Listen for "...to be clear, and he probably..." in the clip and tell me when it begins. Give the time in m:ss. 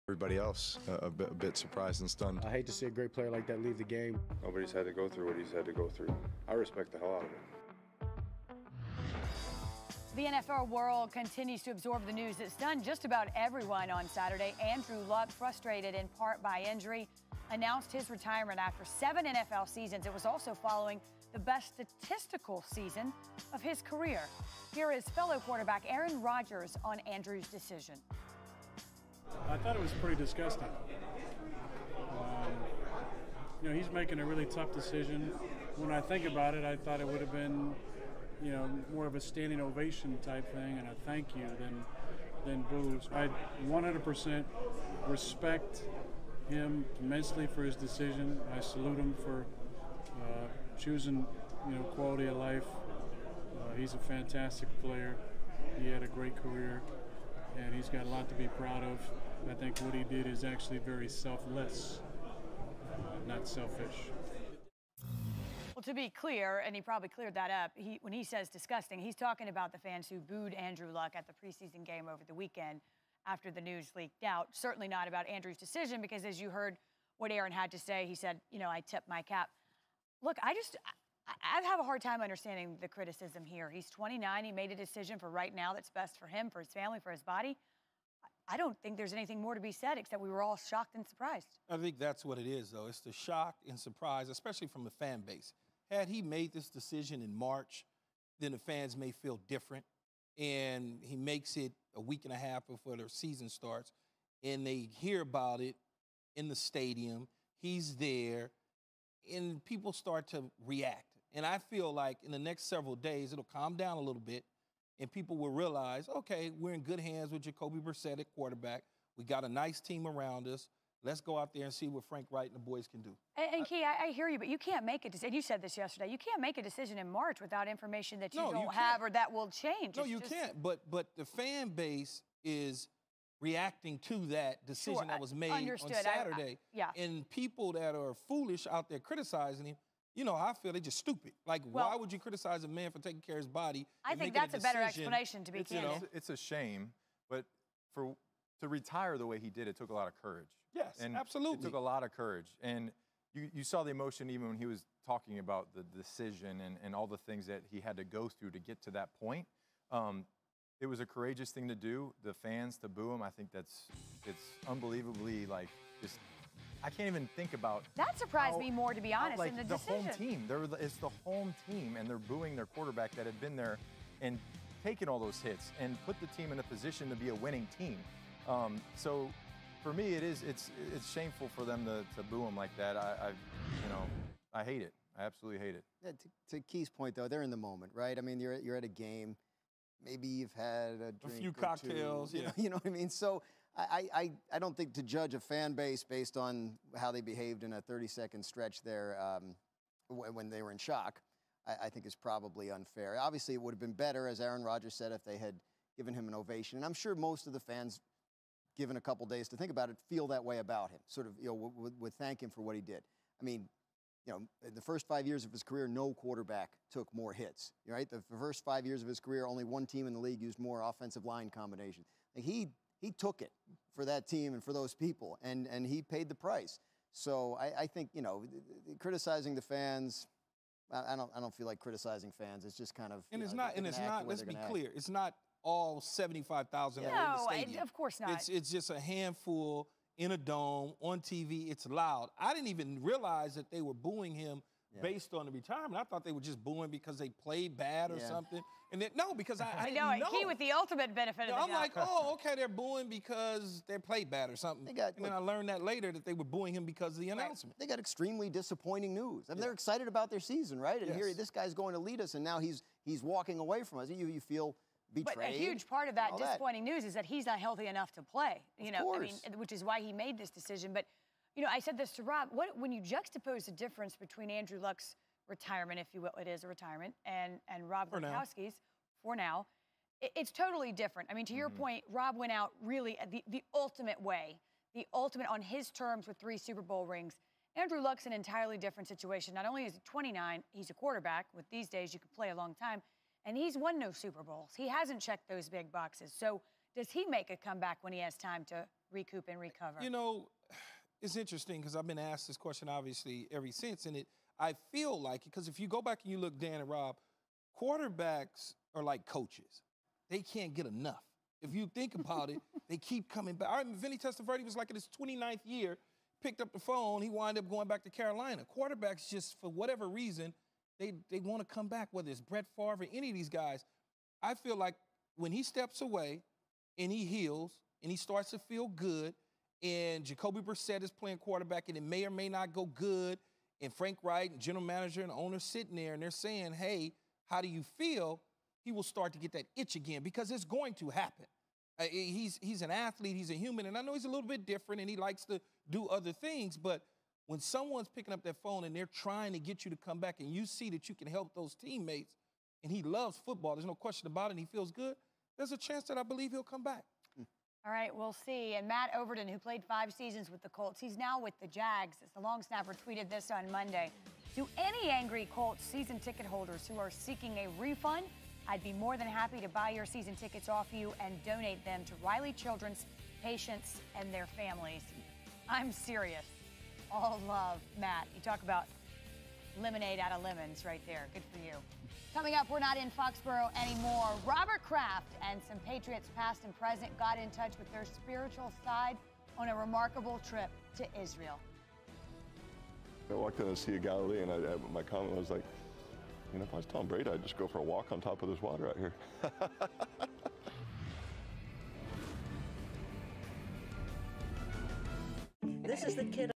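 1:05.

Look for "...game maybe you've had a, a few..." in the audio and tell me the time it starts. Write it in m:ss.
3:08.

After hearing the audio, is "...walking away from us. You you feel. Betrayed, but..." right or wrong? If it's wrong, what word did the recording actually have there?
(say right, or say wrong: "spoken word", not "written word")
right.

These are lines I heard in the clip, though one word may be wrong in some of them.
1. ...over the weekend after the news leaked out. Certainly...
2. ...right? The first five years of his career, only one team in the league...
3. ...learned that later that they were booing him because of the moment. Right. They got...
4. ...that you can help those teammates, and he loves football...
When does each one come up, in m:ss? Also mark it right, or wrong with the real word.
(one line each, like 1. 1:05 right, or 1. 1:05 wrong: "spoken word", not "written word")
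1. 1:12 right
2. 3:37 right
3. 4:15 wrong: "announcement", not "moment"
4. 5:50 right.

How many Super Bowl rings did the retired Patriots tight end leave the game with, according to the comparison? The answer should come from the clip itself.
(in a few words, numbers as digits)
3.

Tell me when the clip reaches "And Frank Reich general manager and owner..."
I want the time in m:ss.
5:33.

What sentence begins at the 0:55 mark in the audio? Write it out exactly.
He had a great career, and he's got a lot to be proud of.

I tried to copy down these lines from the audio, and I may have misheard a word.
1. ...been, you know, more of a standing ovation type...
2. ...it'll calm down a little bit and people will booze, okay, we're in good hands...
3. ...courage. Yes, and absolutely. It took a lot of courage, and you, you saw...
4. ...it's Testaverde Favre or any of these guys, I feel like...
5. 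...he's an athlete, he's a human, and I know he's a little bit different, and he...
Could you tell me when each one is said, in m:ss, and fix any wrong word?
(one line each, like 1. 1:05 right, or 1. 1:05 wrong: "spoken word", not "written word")
1. 0:37 right
2. 1:53 wrong: "realize", not "booze"
3. 2:30 right
4. 5:22 wrong: "Brett", not "Testaverde"
5. 5:42 right.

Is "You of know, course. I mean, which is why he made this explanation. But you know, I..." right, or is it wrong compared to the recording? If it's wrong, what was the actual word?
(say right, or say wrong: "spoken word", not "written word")
wrong: "decision", not "explanation".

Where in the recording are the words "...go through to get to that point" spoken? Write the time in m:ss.
2:38.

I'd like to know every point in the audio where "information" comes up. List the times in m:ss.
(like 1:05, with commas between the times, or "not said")
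2:07.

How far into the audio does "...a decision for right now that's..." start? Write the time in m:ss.
1:24.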